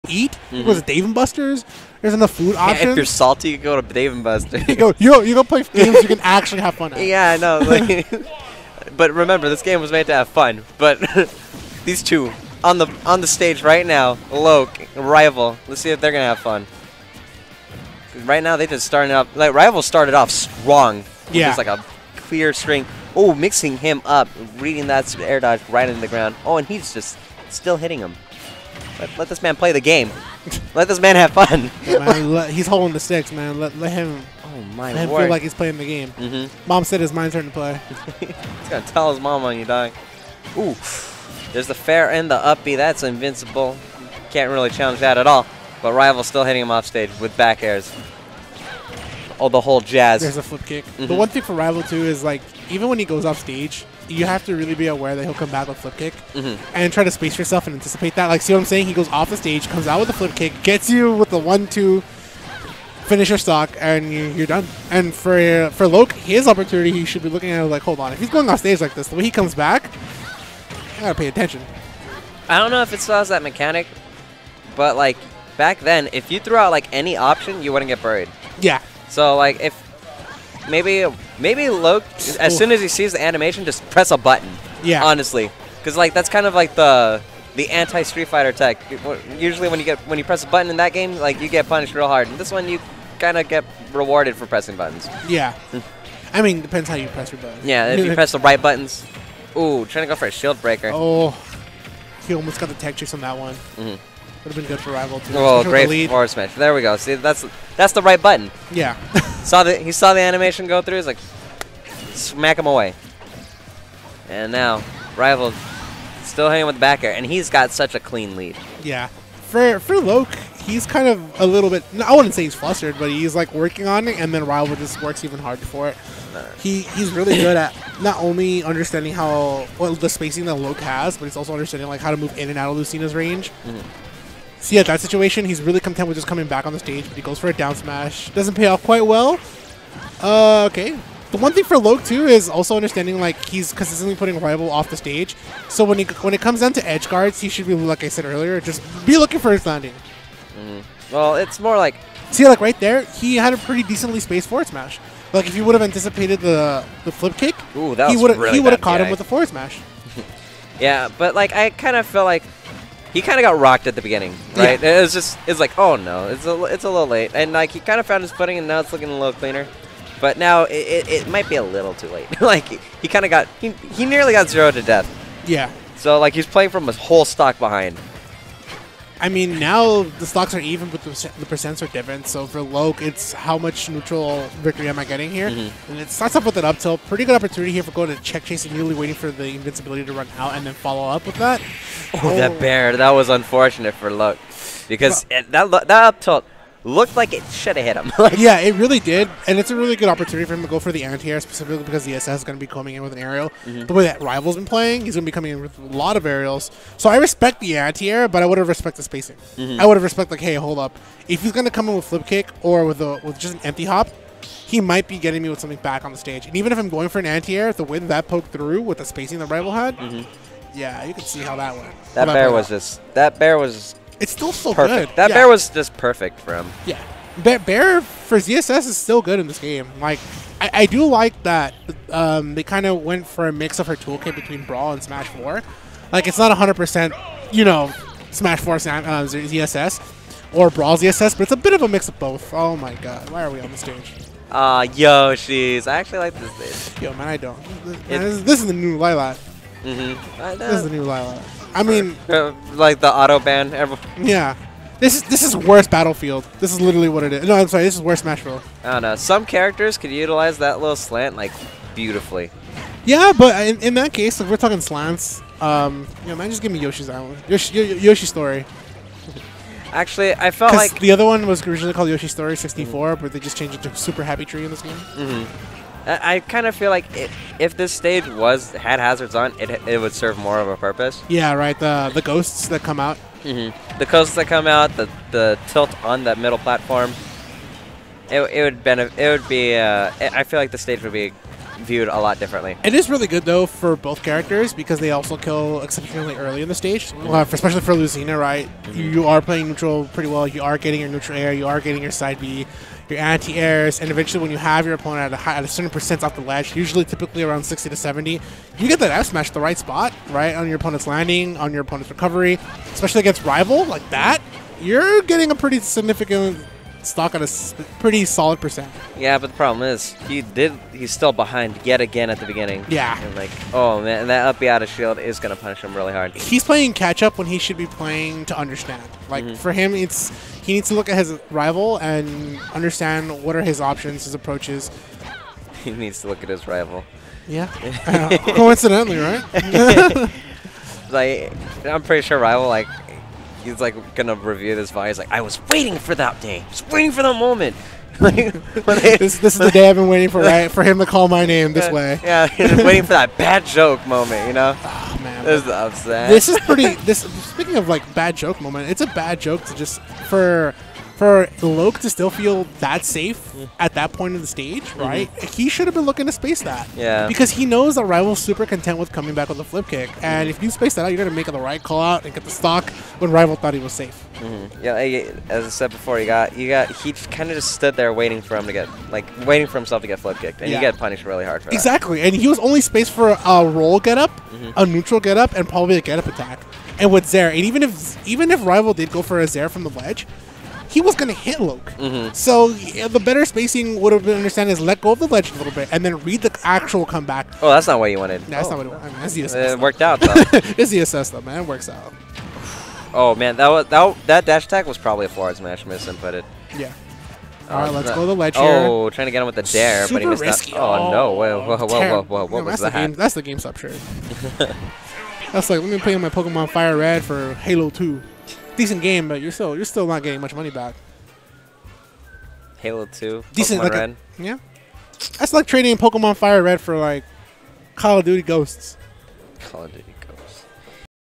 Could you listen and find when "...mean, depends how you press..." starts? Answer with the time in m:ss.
1:36.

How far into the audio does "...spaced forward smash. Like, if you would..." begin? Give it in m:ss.
2:34.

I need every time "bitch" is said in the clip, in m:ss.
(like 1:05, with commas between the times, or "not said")
4:06.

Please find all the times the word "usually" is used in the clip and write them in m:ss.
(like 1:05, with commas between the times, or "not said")
1:29, 5:06.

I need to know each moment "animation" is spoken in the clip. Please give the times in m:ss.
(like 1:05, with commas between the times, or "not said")
1:23, 1:50.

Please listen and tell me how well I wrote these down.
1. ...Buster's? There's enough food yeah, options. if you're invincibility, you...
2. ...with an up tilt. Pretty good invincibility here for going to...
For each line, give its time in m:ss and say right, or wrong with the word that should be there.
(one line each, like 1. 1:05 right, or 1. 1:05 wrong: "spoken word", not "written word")
1. 0:01 wrong: "salty", not "invincibility"
2. 3:06 wrong: "opportunity", not "invincibility".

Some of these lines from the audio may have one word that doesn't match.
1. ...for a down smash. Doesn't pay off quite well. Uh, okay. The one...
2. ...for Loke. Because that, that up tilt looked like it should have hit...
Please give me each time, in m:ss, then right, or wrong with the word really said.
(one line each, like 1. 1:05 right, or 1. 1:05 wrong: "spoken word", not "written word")
1. 2:17 right
2. 3:13 right.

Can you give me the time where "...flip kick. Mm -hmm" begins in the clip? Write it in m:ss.
0:50.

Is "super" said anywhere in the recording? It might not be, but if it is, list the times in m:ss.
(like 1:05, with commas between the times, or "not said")
4:33, 6:08, 6:50.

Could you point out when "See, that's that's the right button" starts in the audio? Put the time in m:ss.
1:46.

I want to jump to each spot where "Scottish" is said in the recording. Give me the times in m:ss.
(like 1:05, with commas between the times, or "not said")
not said.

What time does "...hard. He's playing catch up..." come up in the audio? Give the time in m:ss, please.
5:26.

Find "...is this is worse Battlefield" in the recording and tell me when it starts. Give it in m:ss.
4:15.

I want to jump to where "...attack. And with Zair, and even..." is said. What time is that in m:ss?
6:26.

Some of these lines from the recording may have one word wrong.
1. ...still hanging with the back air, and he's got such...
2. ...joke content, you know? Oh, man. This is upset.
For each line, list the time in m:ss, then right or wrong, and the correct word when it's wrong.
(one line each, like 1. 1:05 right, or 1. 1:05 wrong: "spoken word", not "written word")
1. 1:56 right
2. 5:53 wrong: "moment", not "content".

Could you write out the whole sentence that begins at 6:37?
Oh, that's not what you wanted.